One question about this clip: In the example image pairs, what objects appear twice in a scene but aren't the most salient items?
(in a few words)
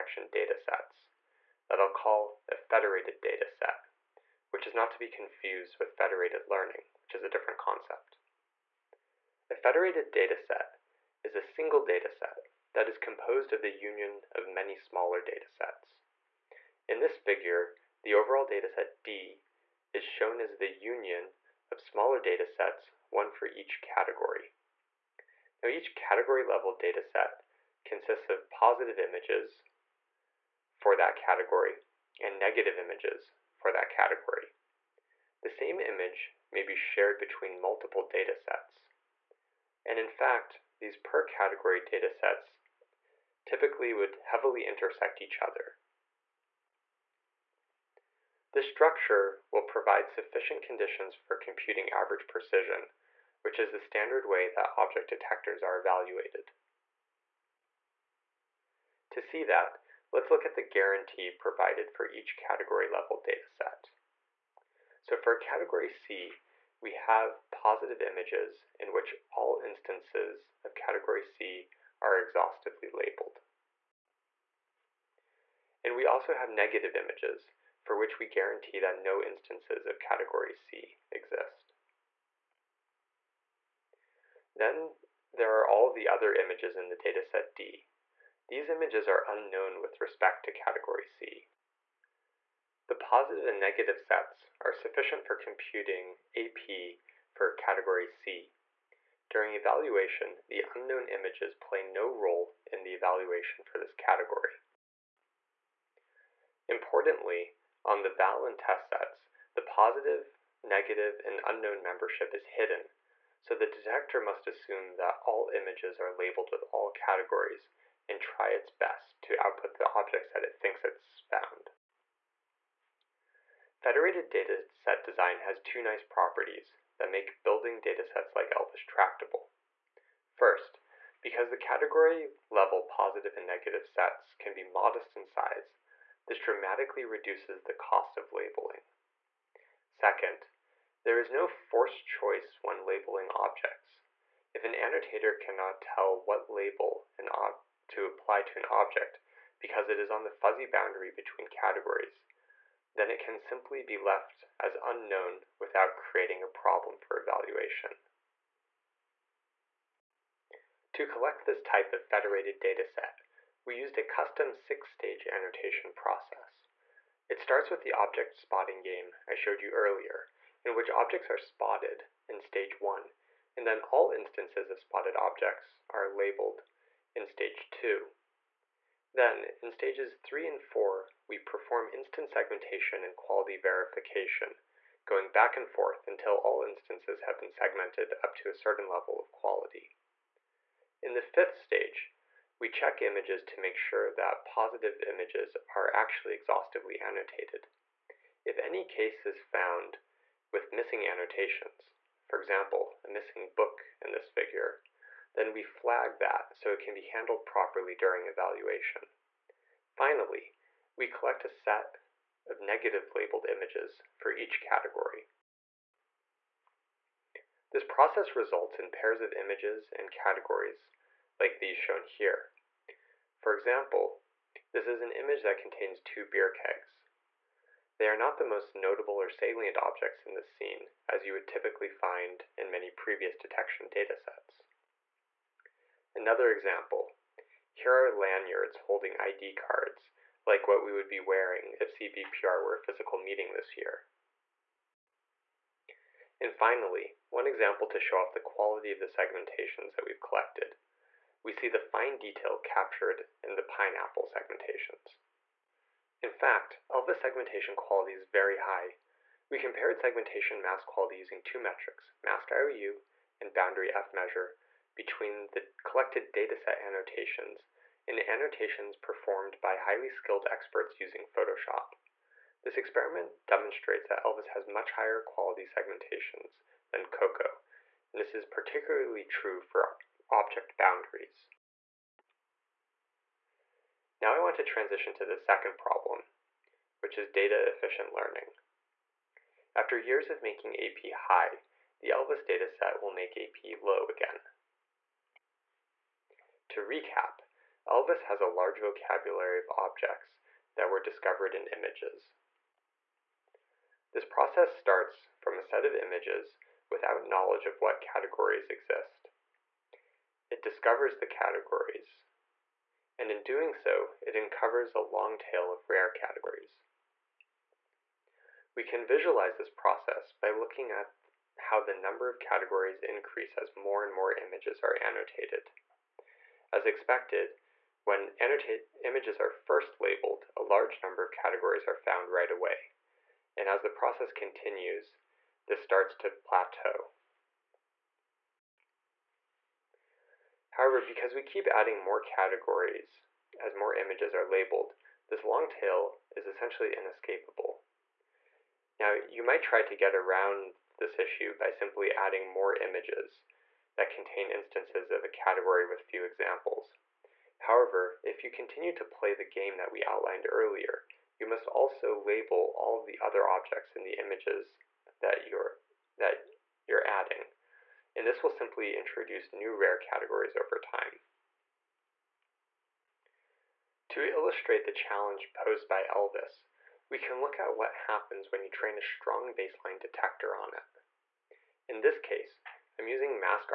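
beer kegs.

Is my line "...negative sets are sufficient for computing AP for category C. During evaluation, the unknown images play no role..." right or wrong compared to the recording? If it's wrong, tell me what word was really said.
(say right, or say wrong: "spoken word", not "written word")
right.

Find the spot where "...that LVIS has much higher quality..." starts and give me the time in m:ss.
4:34.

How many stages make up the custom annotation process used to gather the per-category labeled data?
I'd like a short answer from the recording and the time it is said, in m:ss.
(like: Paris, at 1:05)
6, at 2:44.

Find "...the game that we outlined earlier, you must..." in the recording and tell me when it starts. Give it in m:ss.
5:59.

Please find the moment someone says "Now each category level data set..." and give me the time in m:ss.
0:25.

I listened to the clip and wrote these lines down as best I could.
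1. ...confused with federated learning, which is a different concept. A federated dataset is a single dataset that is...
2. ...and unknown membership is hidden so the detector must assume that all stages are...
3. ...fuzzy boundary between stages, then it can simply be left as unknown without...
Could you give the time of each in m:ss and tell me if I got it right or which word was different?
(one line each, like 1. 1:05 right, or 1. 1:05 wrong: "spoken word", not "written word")
1. 0:05 right
2. 1:51 wrong: "images", not "stages"
3. 2:30 wrong: "categories", not "stages".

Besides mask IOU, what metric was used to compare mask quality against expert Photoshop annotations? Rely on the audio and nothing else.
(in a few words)
boundary F measure.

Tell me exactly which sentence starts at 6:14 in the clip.
To illustrate the challenge posed by LVIS, we can look at what happens when you train a strong baseline detector on it.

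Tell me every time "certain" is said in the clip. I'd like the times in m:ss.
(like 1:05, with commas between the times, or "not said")
3:08.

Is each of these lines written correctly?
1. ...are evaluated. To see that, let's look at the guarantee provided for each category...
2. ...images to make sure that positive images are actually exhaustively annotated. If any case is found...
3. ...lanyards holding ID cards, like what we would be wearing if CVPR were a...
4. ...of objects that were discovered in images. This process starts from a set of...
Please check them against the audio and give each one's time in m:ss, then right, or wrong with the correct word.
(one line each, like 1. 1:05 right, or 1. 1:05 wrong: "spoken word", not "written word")
1. 0:55 right
2. 3:13 right
3. 3:58 right
4. 4:59 right.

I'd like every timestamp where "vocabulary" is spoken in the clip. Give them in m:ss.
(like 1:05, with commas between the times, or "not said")
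4:58.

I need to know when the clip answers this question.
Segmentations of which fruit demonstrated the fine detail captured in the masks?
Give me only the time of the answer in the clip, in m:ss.
4:13.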